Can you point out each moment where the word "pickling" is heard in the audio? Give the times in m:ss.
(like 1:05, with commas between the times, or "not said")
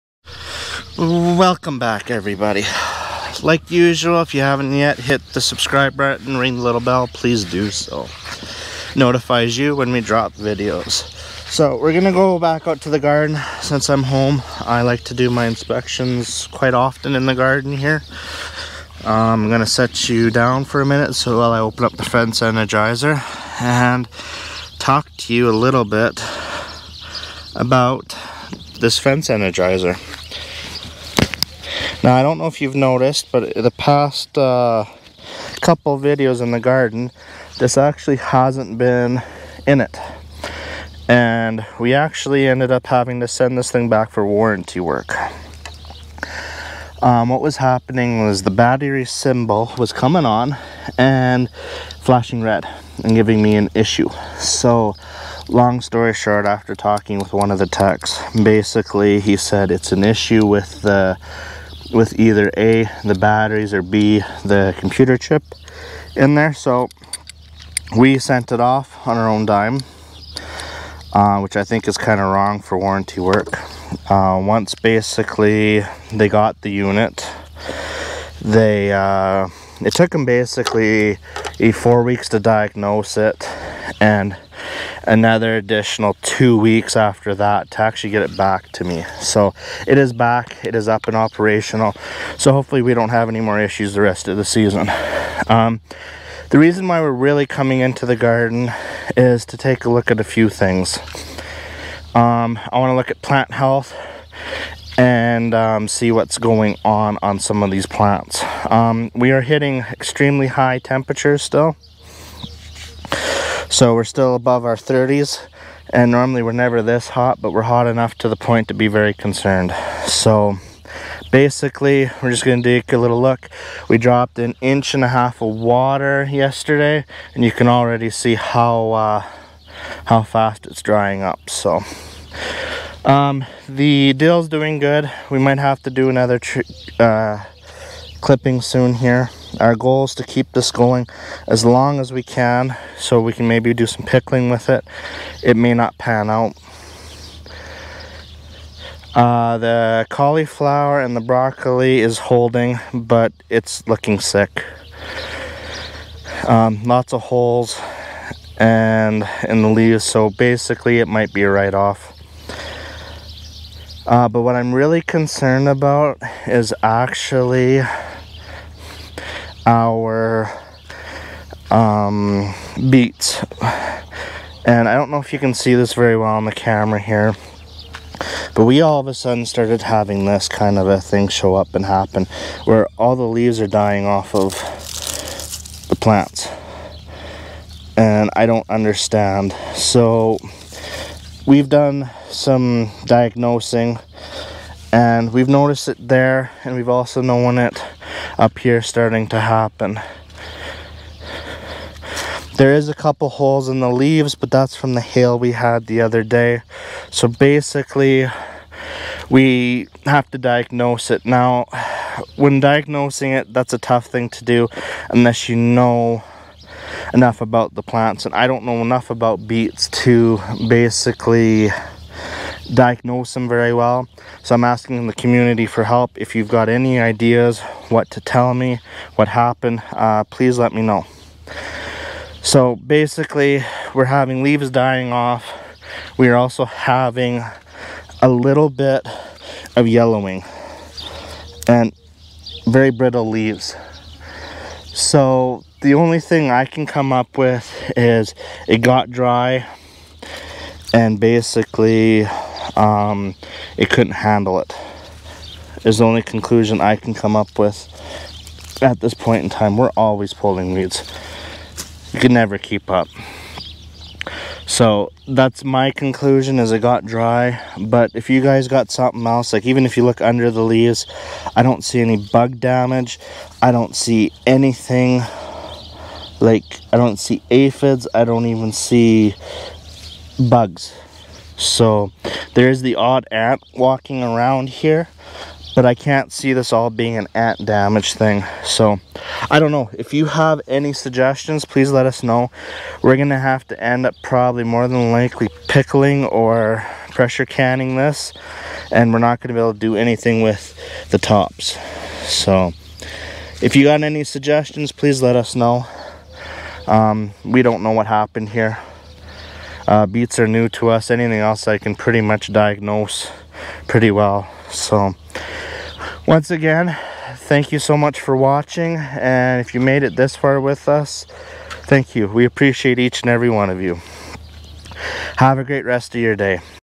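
2:24, 4:55.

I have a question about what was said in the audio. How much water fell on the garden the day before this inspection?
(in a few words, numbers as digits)
1.5 inches.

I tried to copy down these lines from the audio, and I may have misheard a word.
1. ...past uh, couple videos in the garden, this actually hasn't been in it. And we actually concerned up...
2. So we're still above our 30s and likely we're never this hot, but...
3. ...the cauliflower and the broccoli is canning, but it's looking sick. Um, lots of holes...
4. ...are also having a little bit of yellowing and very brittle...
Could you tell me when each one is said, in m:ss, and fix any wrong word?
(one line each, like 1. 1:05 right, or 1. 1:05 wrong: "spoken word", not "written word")
1. 0:33 wrong: "ended", not "concerned"
2. 1:53 wrong: "normally", not "likely"
3. 2:29 wrong: "holding", not "canning"
4. 3:56 right.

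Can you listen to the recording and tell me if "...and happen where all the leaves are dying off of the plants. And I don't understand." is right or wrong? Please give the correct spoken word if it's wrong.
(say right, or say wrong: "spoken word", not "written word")
right.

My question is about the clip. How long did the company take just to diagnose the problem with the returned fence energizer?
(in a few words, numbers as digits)
4 weeks.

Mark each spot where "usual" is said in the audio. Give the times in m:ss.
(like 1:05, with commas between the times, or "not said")
0:03.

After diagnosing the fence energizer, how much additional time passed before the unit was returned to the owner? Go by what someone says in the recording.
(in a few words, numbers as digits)
2 weeks.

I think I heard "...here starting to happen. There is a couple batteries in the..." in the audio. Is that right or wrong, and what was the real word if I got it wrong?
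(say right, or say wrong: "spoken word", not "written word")
wrong: "holes", not "batteries".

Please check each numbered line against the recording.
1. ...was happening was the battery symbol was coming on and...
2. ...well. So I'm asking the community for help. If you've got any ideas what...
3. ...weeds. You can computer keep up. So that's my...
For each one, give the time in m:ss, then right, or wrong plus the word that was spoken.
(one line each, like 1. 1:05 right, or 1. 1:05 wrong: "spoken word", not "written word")
1. 0:47 right
2. 3:43 right
3. 4:20 wrong: "never", not "computer".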